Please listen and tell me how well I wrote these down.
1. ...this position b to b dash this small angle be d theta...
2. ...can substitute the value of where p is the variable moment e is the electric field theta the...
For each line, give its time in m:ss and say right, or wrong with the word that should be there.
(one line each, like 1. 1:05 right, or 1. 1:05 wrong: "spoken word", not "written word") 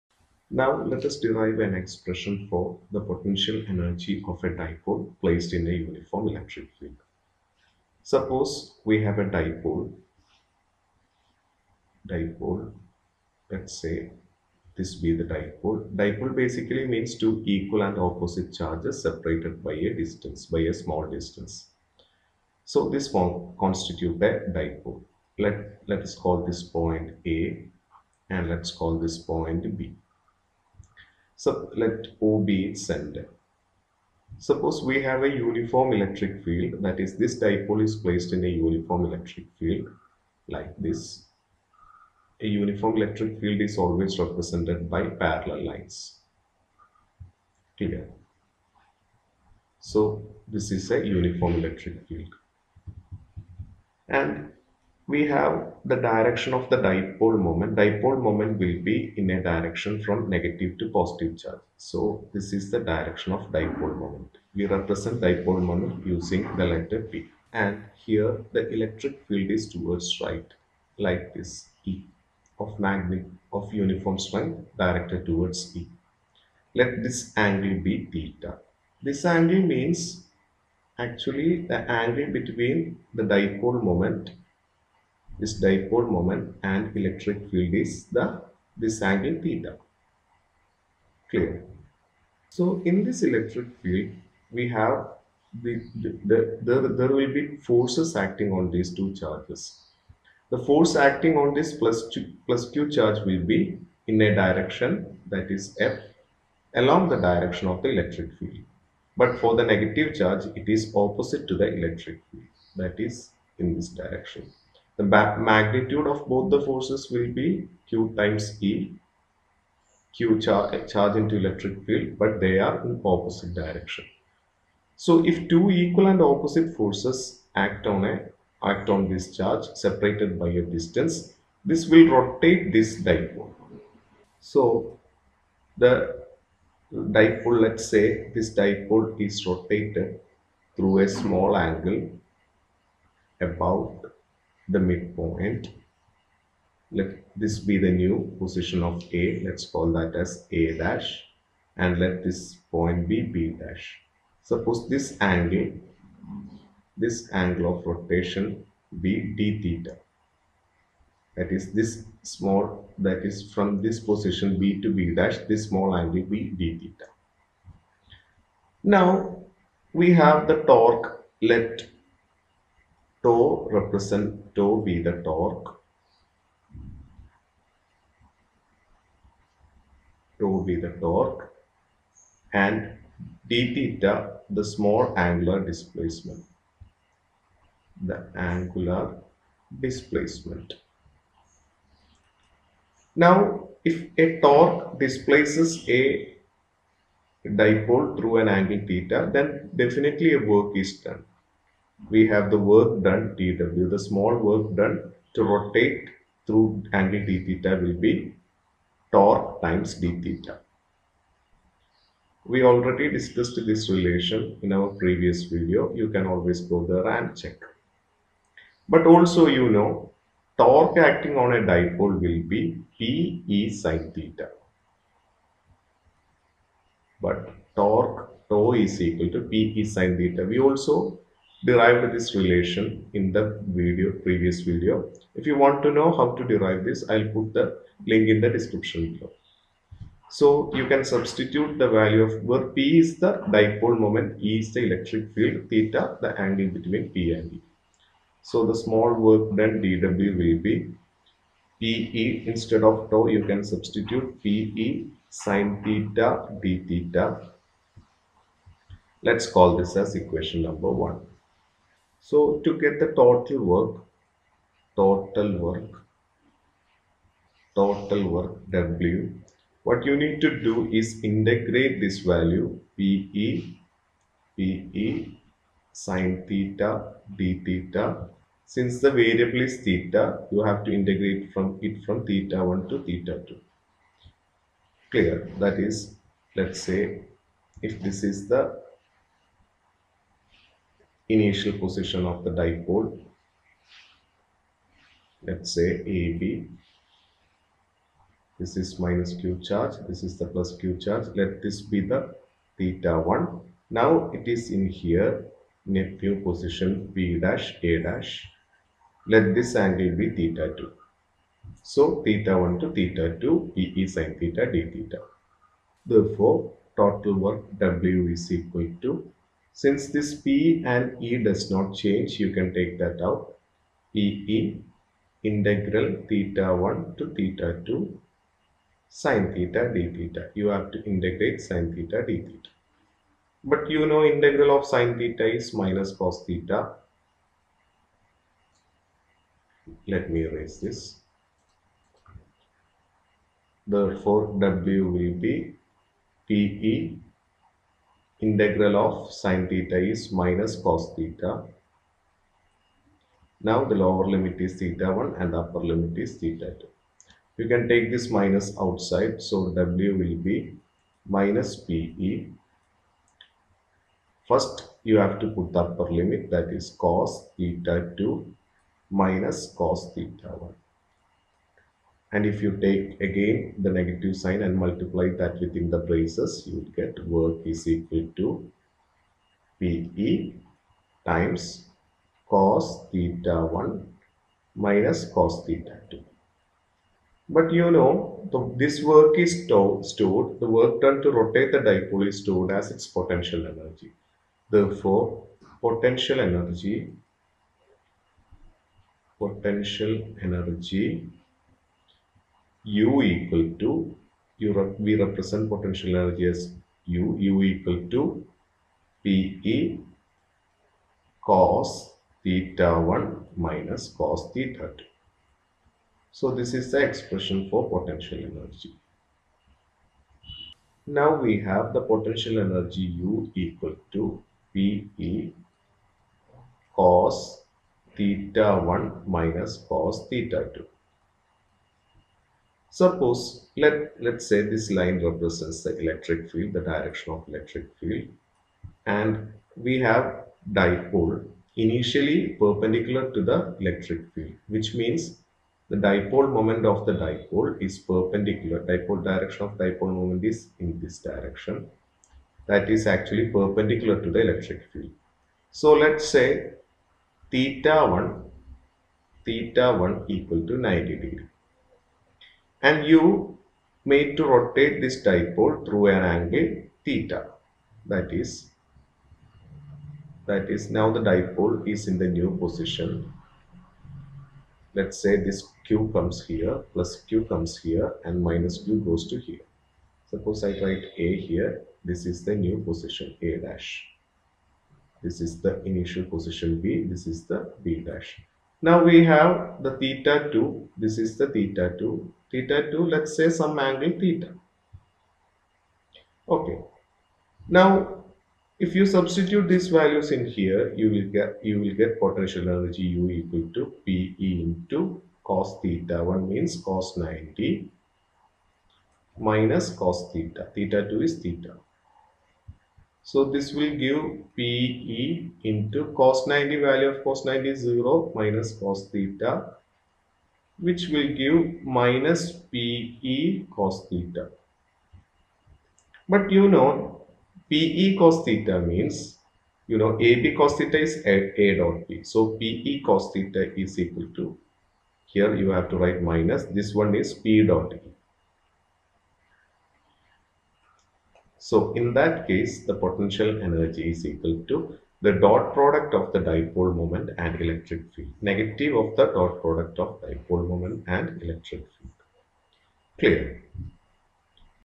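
1. 2:43 right
2. 4:00 wrong: "dipole", not "variable".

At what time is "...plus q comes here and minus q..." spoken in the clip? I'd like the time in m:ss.
7:56.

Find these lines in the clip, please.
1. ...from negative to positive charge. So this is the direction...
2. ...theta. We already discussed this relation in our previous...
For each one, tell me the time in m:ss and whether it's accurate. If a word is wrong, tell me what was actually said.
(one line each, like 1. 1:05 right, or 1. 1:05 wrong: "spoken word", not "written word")
1. 1:00 right
2. 3:30 right.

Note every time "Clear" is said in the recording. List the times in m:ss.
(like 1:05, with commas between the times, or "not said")
0:47, 1:31, 4:45, 9:13.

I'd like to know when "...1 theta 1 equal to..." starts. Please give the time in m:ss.
7:38.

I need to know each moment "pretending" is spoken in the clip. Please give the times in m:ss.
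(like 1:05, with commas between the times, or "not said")
not said.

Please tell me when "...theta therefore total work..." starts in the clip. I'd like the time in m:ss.
5:14.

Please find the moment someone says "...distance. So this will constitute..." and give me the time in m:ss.
0:21.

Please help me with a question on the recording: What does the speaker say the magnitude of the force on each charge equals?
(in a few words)
Q times E.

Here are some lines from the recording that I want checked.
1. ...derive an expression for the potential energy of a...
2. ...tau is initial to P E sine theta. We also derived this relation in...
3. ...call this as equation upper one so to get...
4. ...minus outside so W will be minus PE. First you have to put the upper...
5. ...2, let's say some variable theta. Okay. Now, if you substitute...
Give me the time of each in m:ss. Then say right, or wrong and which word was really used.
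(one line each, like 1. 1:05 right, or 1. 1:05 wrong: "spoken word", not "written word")
1. 0:01 right
2. 3:48 wrong: "equal", not "initial"
3. 4:19 wrong: "number", not "upper"
4. 5:58 right
5. 8:12 wrong: "angle", not "variable".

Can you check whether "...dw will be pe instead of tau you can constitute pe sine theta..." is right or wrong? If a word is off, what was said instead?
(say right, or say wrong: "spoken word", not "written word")
wrong: "substitute", not "constitute".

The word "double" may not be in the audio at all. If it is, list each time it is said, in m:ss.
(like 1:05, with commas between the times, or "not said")
not said.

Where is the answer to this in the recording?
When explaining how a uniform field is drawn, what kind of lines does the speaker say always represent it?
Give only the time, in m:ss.
0:45.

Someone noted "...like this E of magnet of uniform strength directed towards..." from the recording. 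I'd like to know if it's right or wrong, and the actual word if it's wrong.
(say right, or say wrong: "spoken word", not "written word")
right.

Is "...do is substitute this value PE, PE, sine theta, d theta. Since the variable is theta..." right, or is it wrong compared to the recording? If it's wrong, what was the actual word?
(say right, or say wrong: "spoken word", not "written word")
wrong: "integrate", not "substitute".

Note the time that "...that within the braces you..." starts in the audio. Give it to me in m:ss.
6:15.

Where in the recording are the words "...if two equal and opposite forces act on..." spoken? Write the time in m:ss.
2:05.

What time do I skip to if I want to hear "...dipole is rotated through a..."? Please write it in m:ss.
2:18.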